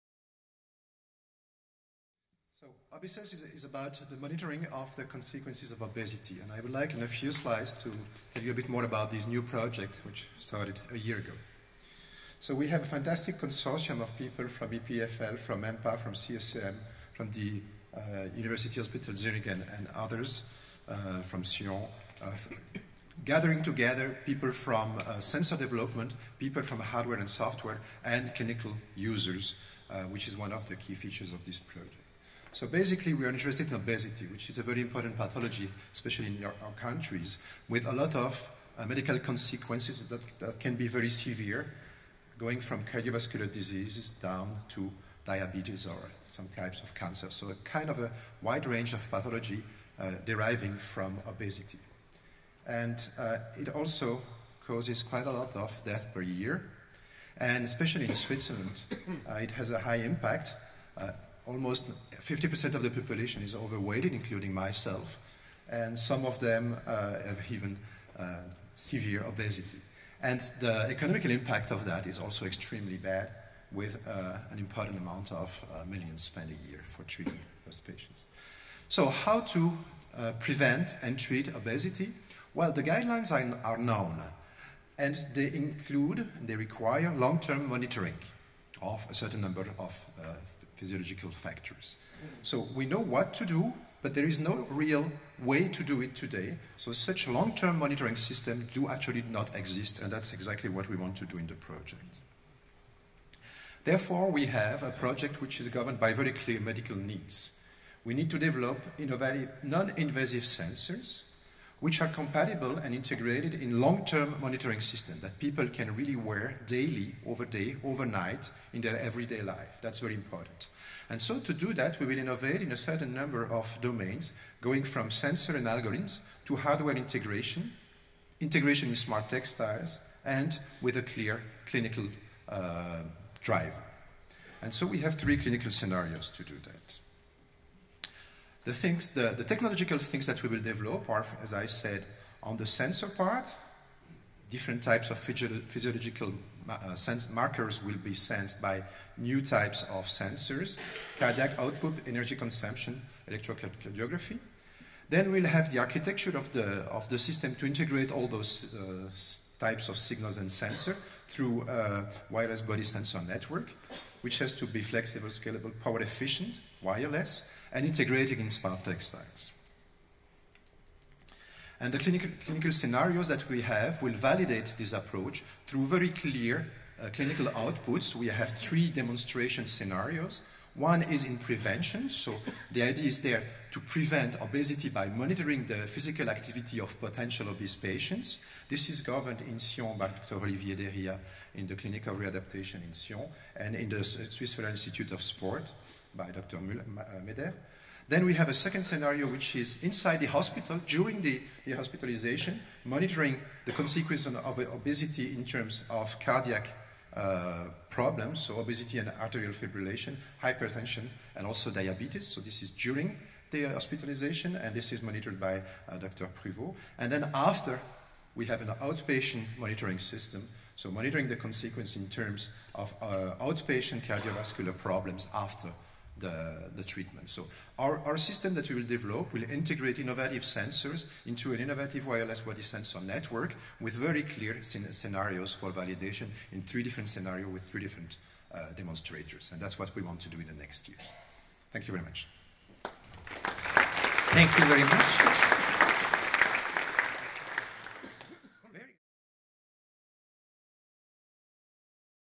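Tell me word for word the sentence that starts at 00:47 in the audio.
So a kind of a wide range of pathology uh, deriving from obesity.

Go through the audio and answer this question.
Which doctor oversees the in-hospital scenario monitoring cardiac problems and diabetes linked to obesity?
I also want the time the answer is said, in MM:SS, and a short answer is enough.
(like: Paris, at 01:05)
Dr. Privot, at 03:35.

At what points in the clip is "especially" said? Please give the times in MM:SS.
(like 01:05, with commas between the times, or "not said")
00:35, 00:57.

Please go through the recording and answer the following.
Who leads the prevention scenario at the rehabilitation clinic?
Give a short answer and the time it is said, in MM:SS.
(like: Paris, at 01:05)
Dr. Olivier Dériaz, at 03:10.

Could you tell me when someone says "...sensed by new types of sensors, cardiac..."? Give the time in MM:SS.
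02:28.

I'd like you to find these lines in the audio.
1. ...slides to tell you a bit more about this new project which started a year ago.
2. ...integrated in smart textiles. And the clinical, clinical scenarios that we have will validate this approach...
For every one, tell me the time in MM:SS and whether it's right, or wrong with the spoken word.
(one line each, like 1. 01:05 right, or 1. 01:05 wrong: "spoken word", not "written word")
1. 00:07 right
2. 02:47 right.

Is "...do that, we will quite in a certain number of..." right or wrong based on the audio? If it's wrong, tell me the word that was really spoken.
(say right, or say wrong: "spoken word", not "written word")
wrong: "innovate", not "quite".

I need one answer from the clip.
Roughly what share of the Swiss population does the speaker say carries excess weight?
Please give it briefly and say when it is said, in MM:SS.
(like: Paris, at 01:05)
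50%, at 01:02.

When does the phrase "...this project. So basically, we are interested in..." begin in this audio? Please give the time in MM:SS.
00:31.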